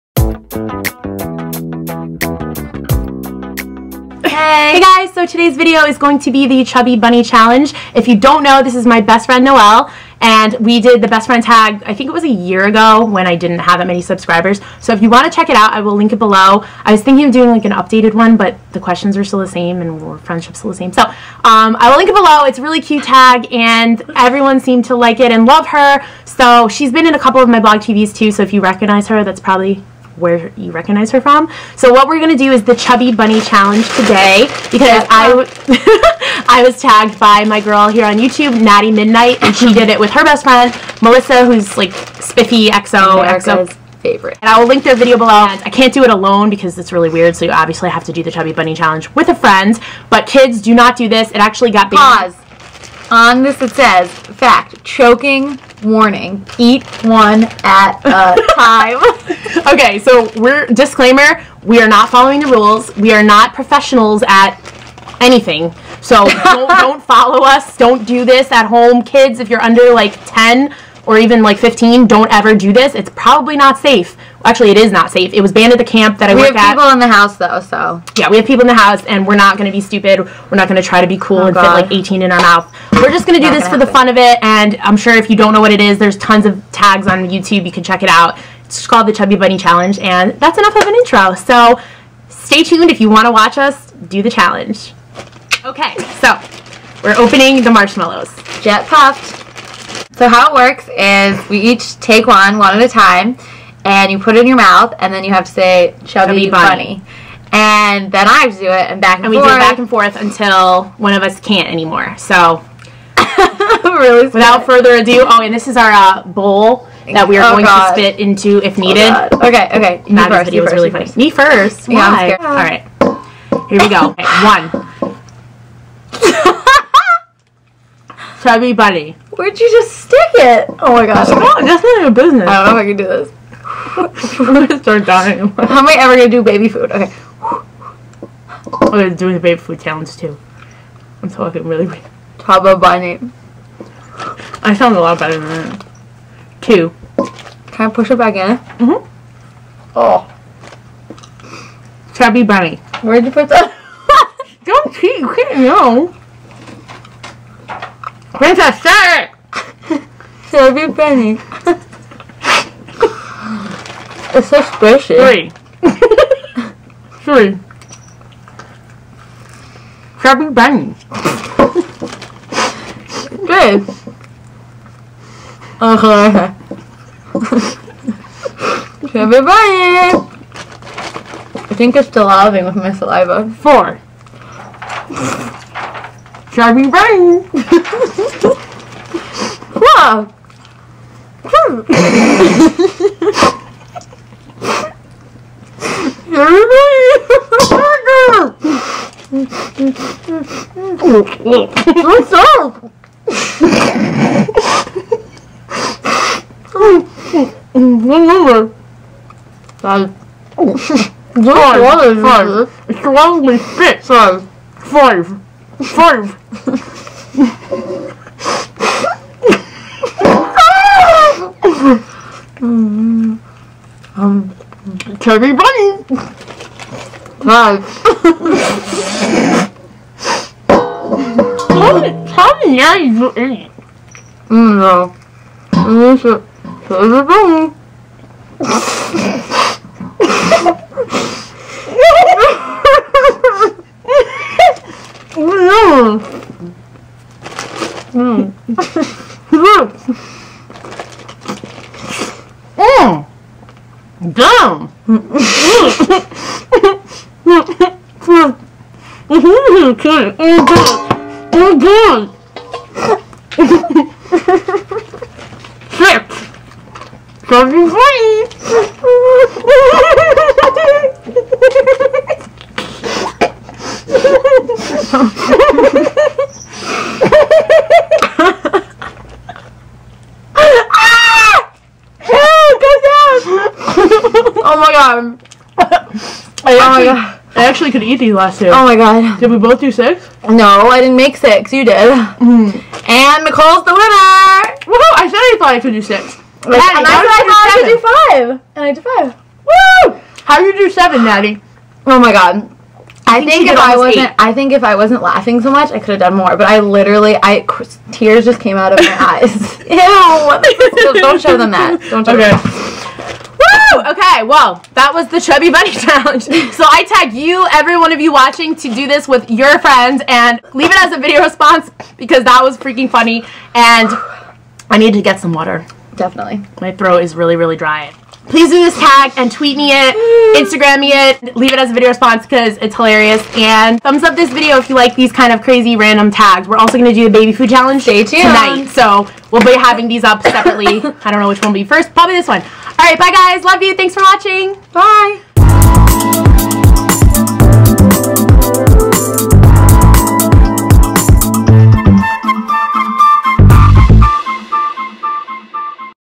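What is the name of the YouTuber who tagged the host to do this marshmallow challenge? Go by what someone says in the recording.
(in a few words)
Naty Midnight.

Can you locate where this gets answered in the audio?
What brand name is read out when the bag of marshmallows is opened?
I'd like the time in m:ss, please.
1:38.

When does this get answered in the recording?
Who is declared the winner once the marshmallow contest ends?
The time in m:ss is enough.
4:53.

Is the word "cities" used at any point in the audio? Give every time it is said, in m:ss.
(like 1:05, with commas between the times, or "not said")
not said.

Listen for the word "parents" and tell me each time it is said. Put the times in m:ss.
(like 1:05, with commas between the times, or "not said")
not said.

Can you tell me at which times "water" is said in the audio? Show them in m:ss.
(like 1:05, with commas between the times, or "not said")
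3:31, 5:25.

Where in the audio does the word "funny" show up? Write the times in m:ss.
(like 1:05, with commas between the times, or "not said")
2:00, 5:23.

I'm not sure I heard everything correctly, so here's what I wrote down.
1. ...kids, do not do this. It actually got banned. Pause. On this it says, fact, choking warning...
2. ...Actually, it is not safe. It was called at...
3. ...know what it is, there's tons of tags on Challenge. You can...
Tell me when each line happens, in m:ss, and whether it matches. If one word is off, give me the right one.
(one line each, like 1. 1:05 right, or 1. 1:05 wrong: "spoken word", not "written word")
1. 0:50 right
2. 1:14 wrong: "banned", not "called"
3. 1:25 wrong: "YouTube", not "Challenge".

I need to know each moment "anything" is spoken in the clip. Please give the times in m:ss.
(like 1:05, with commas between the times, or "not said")
1:05.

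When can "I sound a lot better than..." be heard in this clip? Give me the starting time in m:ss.
2:24.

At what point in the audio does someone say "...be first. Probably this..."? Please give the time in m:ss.
5:41.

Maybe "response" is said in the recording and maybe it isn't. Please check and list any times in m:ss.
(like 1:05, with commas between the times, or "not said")
5:21, 5:32.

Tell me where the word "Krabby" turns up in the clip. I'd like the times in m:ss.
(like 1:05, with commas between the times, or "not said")
2:50, 2:59, 3:06.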